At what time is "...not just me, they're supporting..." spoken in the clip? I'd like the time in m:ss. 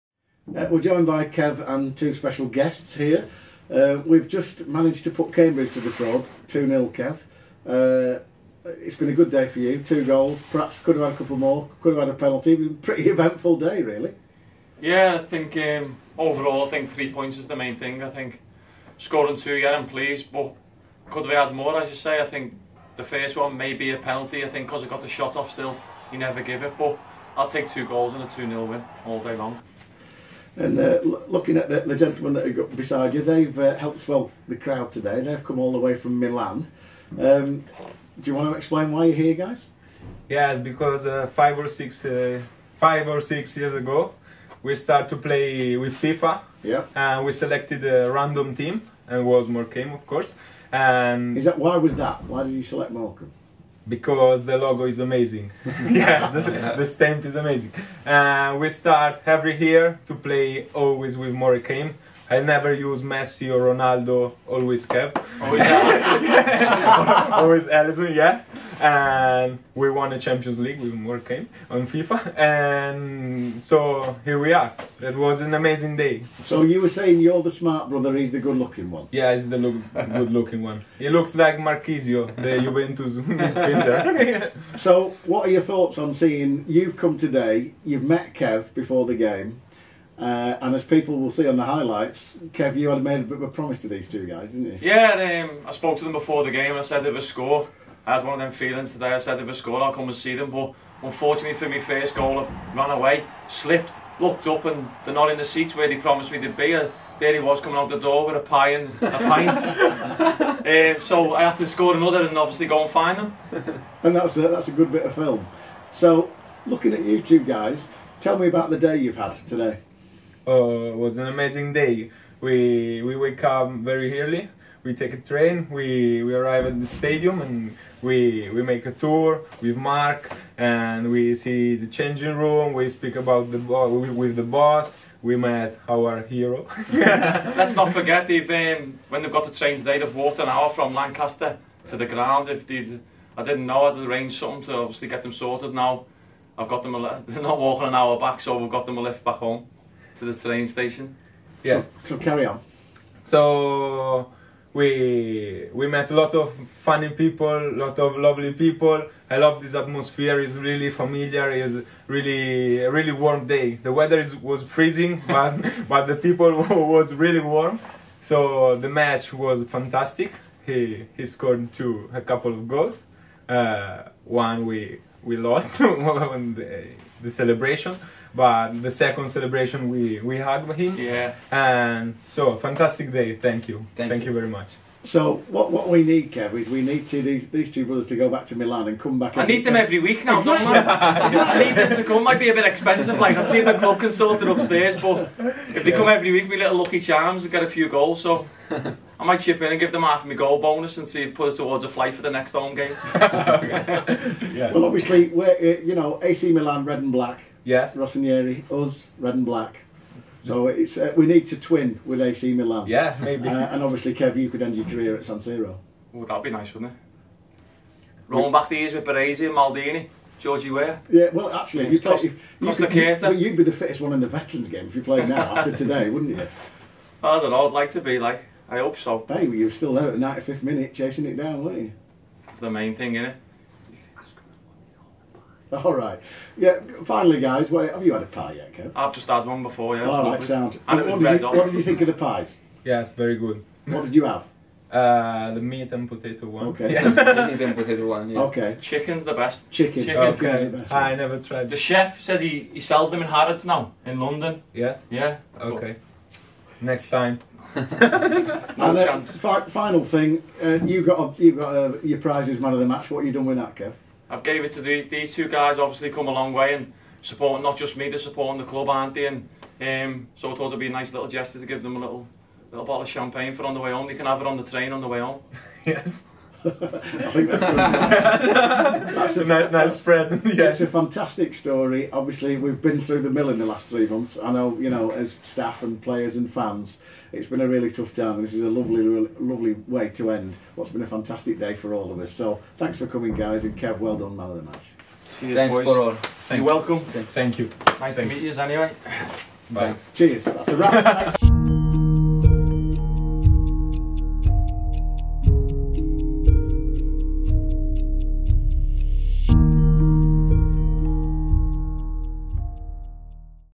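4:27.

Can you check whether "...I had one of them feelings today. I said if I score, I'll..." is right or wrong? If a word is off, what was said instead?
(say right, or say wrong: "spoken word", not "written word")
right.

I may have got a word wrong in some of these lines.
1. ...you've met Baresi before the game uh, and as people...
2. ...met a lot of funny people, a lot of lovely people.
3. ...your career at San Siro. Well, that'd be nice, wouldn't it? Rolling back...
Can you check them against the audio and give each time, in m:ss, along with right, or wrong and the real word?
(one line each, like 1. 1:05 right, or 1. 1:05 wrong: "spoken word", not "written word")
1. 1:27 wrong: "Kev", not "Baresi"
2. 2:35 right
3. 3:34 right.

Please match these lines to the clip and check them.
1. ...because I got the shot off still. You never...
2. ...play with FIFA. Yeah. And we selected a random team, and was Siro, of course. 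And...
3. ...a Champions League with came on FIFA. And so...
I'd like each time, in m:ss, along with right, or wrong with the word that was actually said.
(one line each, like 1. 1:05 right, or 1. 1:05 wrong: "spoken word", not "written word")
1. 0:24 right
2. 0:45 wrong: "Morecambe", not "Siro"
3. 1:10 right.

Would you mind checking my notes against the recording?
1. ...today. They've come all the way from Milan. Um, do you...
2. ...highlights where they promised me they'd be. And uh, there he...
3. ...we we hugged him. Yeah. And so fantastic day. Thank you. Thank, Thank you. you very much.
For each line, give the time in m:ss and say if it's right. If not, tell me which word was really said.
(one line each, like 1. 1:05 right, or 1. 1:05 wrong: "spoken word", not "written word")
1. 0:34 right
2. 1:45 wrong: "seats", not "highlights"
3. 2:59 right.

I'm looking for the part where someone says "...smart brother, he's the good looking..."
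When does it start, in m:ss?
1:17.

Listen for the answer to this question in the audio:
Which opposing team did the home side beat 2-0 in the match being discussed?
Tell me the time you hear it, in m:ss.
0:05.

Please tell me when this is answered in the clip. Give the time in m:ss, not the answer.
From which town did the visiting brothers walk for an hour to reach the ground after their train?
2:20.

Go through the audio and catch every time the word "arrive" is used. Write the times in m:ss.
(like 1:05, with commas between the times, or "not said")
2:06.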